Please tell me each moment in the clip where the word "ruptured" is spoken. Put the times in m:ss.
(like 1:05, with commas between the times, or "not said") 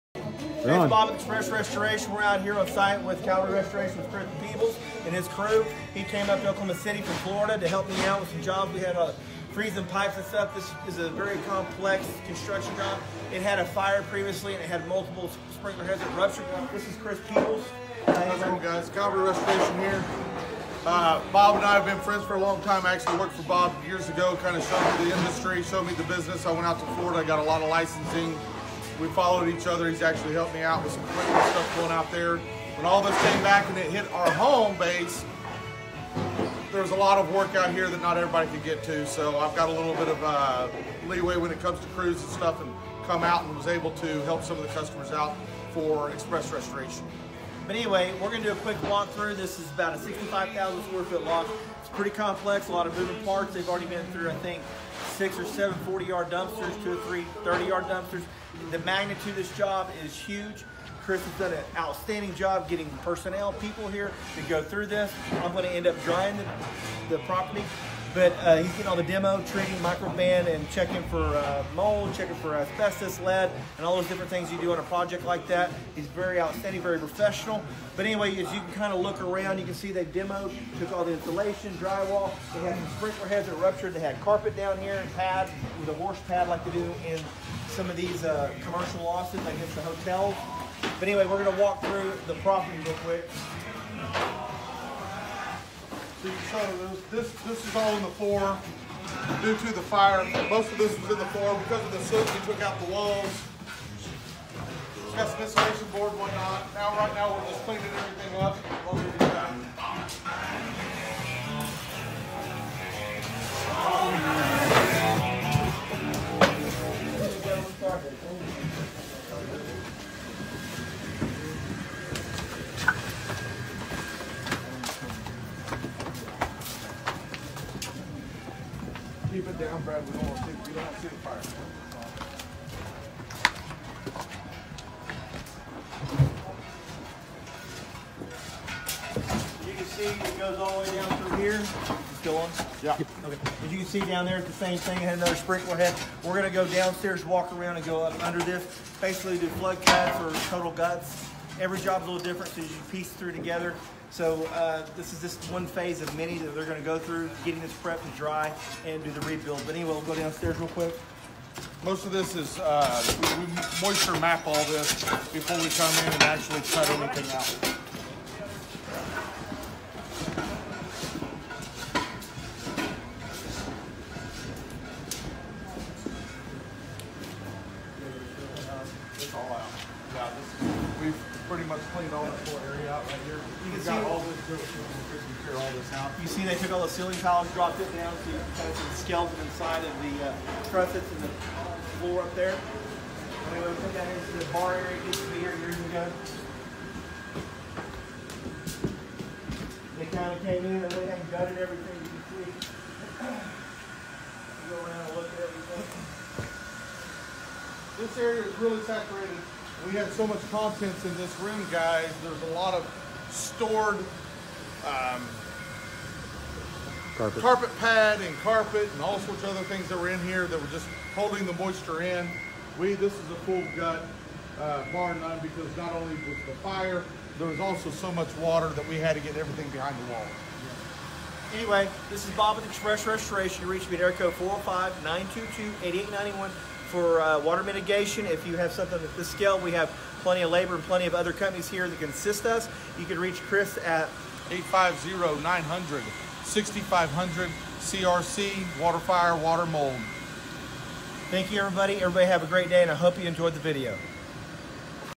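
0:16, 1:23.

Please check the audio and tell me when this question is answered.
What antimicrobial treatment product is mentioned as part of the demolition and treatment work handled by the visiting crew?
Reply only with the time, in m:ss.
1:09.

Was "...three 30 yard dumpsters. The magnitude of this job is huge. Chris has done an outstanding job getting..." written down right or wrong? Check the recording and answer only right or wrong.
right.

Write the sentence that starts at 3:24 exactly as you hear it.
Go around and look at everything.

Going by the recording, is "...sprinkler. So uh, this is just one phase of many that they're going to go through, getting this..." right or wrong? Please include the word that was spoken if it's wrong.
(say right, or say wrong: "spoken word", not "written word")
wrong: "together", not "sprinkler".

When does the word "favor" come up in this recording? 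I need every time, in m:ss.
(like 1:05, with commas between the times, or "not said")
not said.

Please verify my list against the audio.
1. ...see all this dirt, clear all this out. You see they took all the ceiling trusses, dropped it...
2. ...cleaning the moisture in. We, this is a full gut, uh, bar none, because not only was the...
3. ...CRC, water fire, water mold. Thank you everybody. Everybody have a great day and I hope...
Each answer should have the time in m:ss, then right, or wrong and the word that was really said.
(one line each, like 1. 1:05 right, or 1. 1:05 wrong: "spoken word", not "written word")
1. 3:03 wrong: "tiles", not "trusses"
2. 3:41 wrong: "holding", not "cleaning"
3. 4:07 right.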